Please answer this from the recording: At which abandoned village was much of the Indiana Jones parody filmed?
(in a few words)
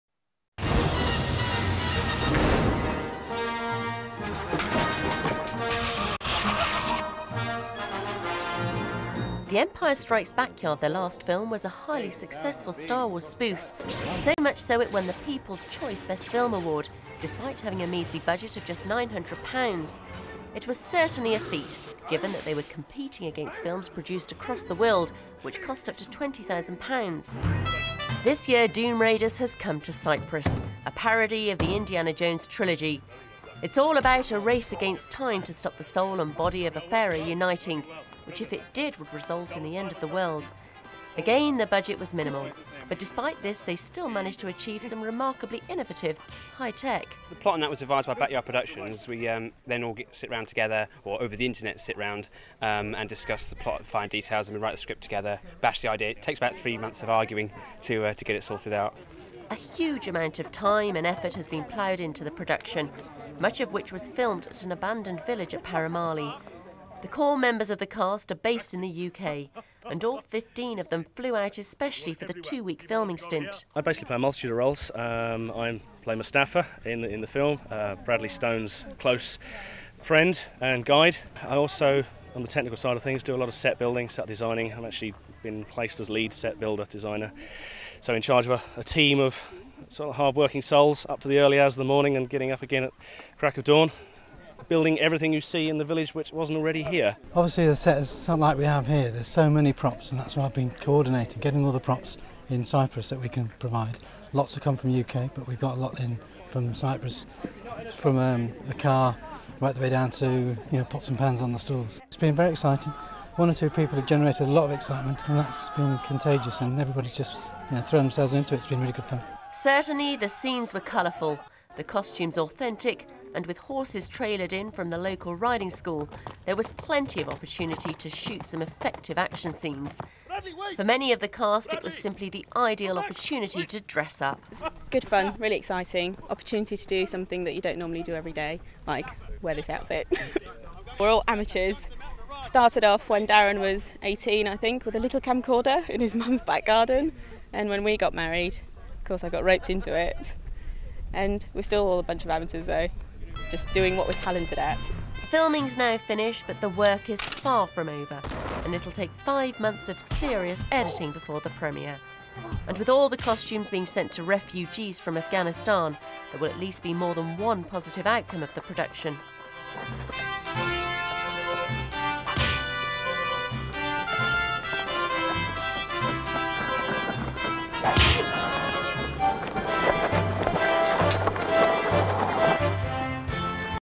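Paramali.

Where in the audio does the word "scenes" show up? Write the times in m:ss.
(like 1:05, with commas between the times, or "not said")
2:00, 2:09.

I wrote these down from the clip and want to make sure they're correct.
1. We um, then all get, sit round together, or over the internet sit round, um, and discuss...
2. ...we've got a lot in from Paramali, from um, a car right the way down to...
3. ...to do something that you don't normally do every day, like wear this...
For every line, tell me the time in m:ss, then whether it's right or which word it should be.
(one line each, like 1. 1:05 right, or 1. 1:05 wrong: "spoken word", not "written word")
1. 0:49 right
2. 1:45 wrong: "Cyprus", not "Paramali"
3. 2:16 right.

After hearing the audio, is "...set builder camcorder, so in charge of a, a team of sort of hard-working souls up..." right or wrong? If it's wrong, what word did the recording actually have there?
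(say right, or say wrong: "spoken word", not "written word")
wrong: "designer", not "camcorder".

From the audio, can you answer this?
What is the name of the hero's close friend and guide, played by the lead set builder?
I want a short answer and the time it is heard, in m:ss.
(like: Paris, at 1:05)
Mustafa, at 1:16.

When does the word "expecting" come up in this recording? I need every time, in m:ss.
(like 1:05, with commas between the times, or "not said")
not said.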